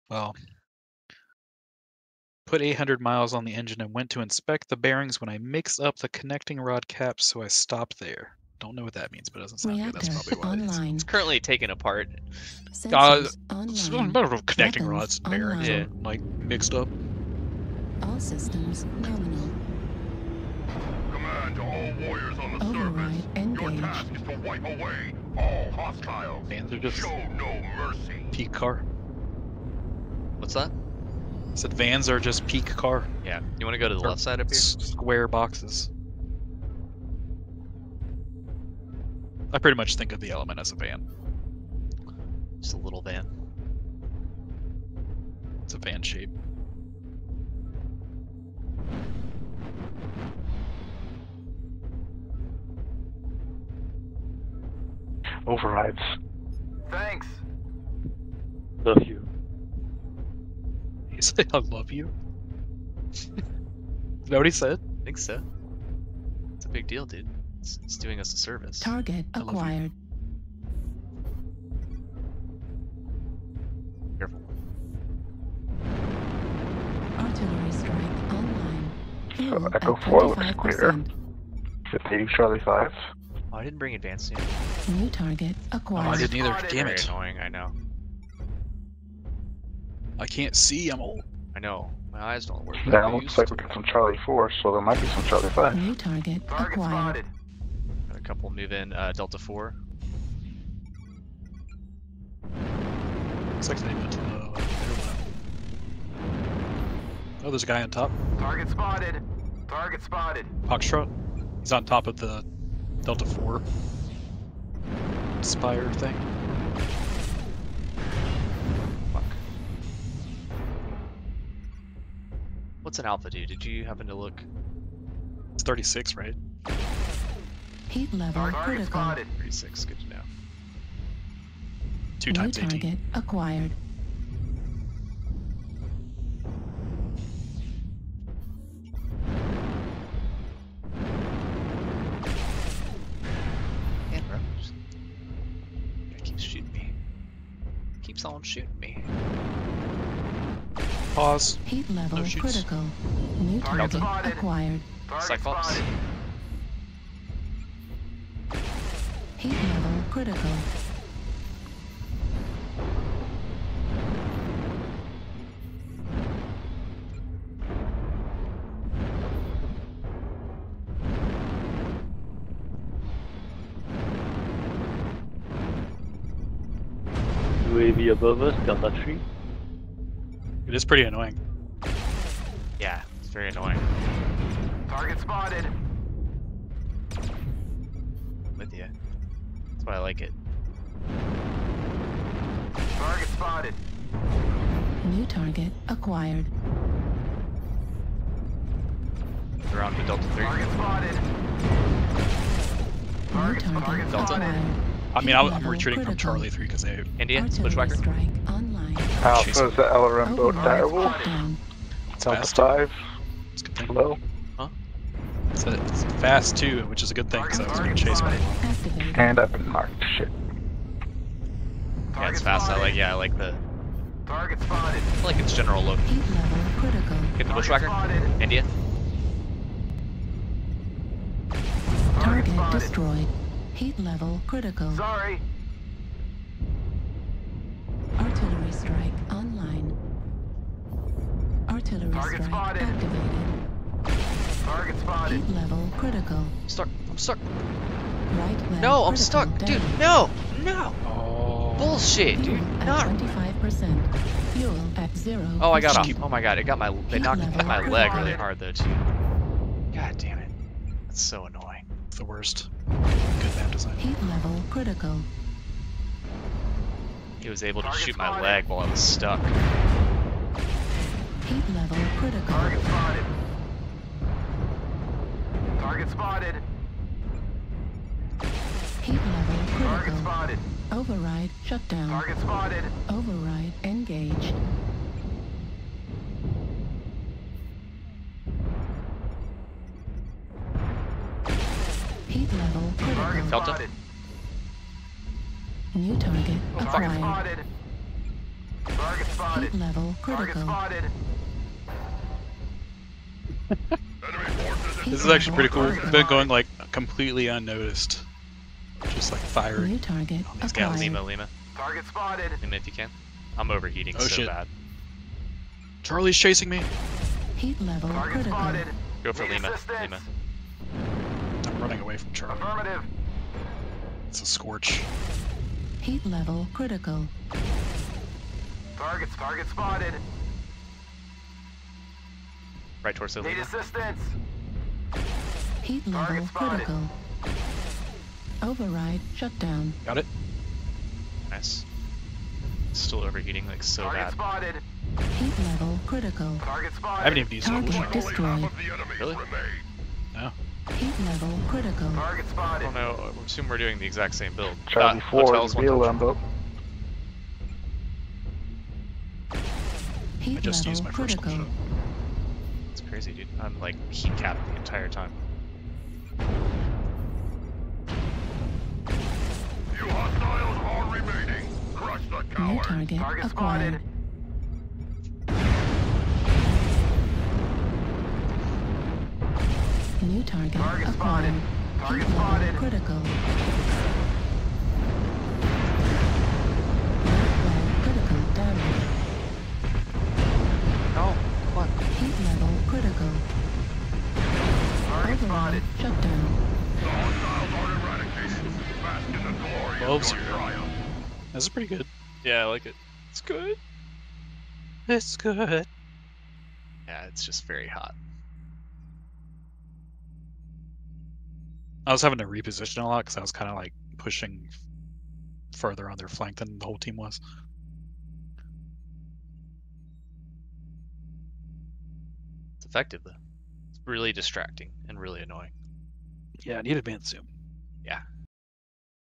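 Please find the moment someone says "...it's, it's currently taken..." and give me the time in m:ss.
0:10.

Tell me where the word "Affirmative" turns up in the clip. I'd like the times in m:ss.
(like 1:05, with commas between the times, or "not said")
5:22.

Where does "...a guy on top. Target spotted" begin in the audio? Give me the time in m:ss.
1:47.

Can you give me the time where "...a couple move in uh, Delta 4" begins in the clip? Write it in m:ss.
1:38.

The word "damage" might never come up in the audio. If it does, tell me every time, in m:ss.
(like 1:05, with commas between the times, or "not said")
1:24, 6:28.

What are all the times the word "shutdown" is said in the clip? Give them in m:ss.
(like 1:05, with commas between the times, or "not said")
4:41, 5:39, 6:35.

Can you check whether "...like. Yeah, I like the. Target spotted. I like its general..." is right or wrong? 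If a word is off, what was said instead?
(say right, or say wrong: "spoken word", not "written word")
right.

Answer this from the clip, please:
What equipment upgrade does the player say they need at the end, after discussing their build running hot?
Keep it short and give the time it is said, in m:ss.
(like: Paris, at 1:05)
Advanced zoom, at 7:06.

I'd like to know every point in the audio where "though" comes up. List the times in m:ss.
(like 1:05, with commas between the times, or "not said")
4:18, 7:03.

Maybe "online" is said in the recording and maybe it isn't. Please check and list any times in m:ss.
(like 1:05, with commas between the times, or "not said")
1:18, 3:59.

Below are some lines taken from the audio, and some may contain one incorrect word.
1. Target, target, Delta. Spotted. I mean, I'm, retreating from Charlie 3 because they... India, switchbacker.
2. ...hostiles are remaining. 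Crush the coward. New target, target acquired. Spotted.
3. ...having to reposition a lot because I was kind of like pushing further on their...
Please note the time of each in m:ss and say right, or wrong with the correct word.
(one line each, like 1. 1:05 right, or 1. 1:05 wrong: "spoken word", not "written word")
1. 3:23 right
2. 6:10 right
3. 6:52 right.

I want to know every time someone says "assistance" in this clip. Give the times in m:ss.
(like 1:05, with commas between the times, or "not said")
5:19, 5:33.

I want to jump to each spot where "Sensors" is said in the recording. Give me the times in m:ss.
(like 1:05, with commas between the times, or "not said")
0:12.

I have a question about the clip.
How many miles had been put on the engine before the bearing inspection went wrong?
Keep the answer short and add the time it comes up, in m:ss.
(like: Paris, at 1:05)
800, at 0:02.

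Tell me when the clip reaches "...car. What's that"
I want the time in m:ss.
0:28.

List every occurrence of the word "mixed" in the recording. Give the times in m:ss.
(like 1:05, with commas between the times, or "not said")
0:05, 0:16.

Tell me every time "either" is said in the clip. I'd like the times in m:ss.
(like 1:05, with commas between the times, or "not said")
1:26.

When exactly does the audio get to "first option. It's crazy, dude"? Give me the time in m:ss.
6:01.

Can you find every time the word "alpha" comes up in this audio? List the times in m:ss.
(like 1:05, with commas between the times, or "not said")
2:03, 3:29.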